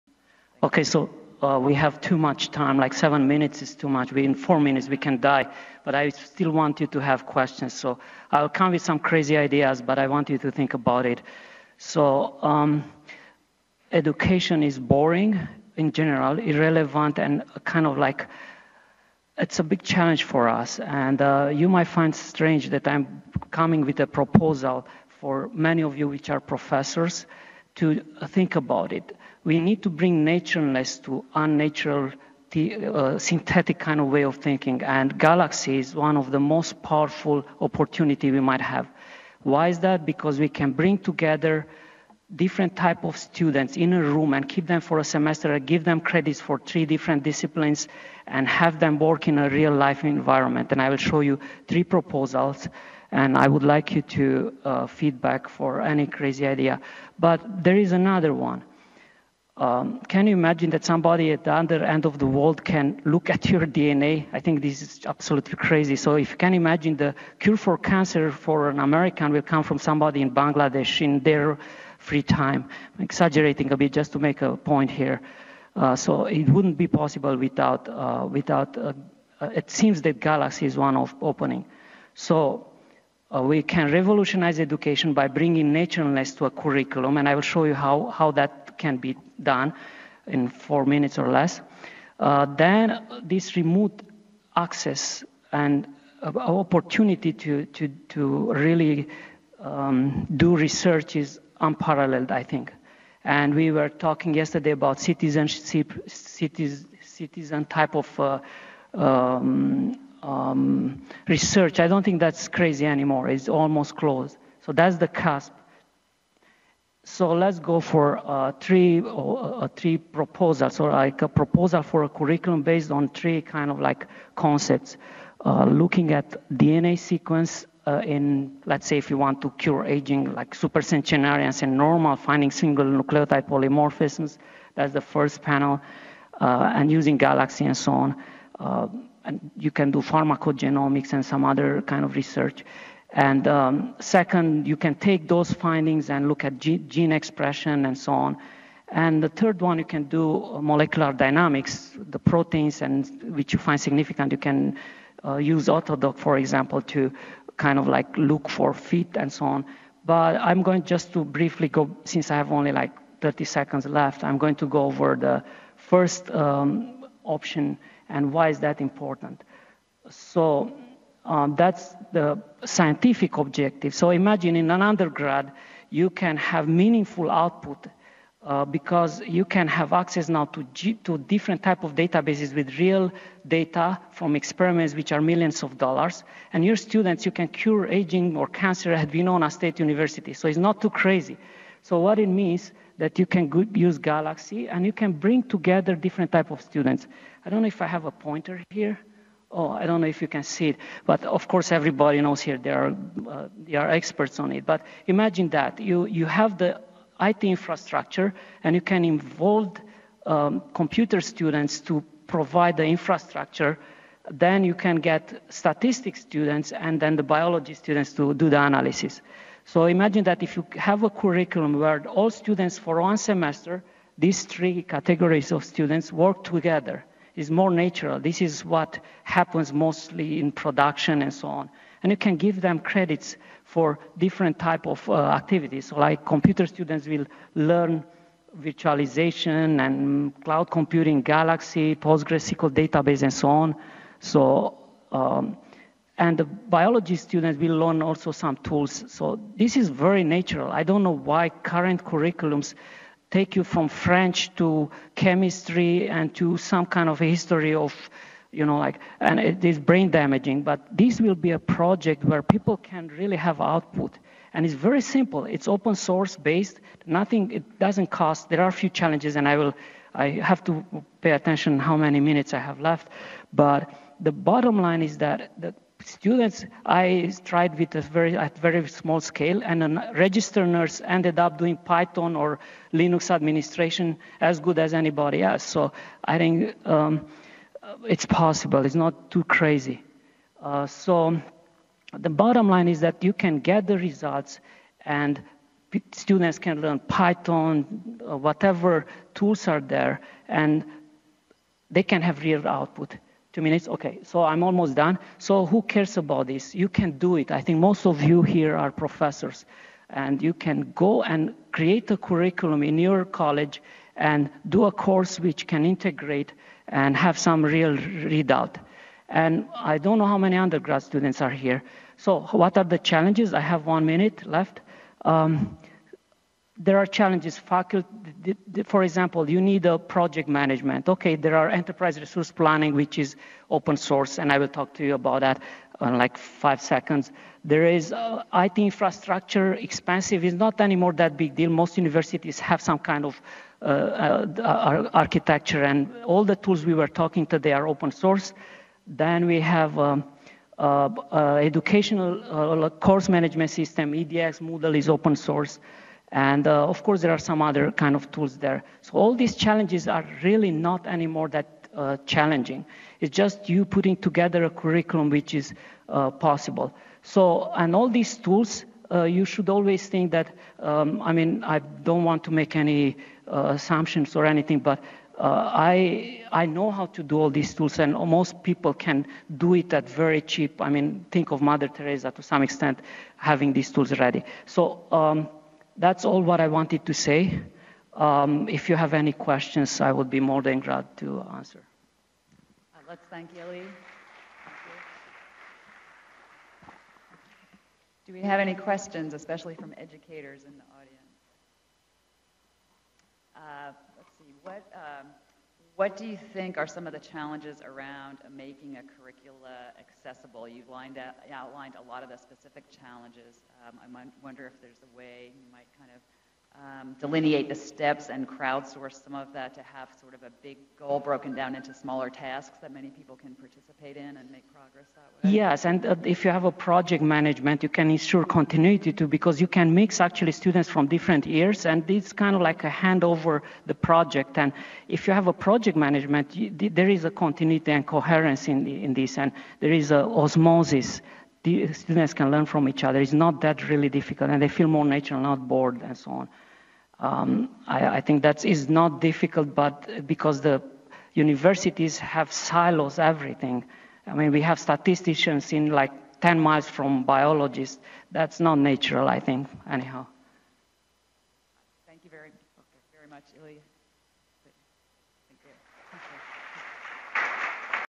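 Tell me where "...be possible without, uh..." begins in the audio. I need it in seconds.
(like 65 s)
76 s.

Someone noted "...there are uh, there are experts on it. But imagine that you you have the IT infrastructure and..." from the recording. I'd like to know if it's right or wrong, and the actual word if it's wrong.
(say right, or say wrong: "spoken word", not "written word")
right.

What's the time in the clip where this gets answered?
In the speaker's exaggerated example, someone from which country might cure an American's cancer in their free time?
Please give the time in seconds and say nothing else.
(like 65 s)
70 s.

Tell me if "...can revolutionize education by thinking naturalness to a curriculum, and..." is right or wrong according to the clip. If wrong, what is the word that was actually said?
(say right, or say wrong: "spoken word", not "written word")
wrong: "bringing", not "thinking".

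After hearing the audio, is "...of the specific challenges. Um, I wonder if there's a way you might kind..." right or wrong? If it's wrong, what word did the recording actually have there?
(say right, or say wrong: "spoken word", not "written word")
right.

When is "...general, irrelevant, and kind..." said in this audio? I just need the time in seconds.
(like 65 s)
15 s.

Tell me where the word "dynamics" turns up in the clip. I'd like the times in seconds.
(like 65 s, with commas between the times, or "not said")
151 s.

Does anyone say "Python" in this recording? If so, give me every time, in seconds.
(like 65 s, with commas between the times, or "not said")
281 s, 296 s.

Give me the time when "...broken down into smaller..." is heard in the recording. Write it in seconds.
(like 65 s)
421 s.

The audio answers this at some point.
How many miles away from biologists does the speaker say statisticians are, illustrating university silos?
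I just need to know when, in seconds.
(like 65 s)
456 s.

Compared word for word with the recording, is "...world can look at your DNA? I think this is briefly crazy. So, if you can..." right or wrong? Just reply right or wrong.
wrong.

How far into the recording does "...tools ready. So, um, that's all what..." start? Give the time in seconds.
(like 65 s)
383 s.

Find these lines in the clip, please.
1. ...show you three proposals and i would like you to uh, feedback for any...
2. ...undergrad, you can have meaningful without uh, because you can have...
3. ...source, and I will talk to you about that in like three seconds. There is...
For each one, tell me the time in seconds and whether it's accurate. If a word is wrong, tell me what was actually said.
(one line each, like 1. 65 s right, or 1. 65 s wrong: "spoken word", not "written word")
1. 50 s right
2. 174 s wrong: "output", not "without"
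3. 333 s wrong: "five", not "three".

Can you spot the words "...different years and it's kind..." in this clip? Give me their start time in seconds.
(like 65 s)
431 s.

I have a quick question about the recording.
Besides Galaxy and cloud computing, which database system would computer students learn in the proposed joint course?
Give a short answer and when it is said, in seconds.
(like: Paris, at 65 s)
PostgreSQL, at 241 s.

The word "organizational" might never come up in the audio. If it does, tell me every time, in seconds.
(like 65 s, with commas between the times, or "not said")
not said.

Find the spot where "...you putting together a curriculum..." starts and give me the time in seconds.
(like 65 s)
363 s.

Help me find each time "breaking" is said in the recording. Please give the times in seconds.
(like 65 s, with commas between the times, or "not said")
not said.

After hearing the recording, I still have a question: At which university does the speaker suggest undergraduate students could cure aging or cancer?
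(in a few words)
Winona State University.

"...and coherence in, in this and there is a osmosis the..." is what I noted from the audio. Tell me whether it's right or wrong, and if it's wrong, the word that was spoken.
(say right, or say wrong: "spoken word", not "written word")
right.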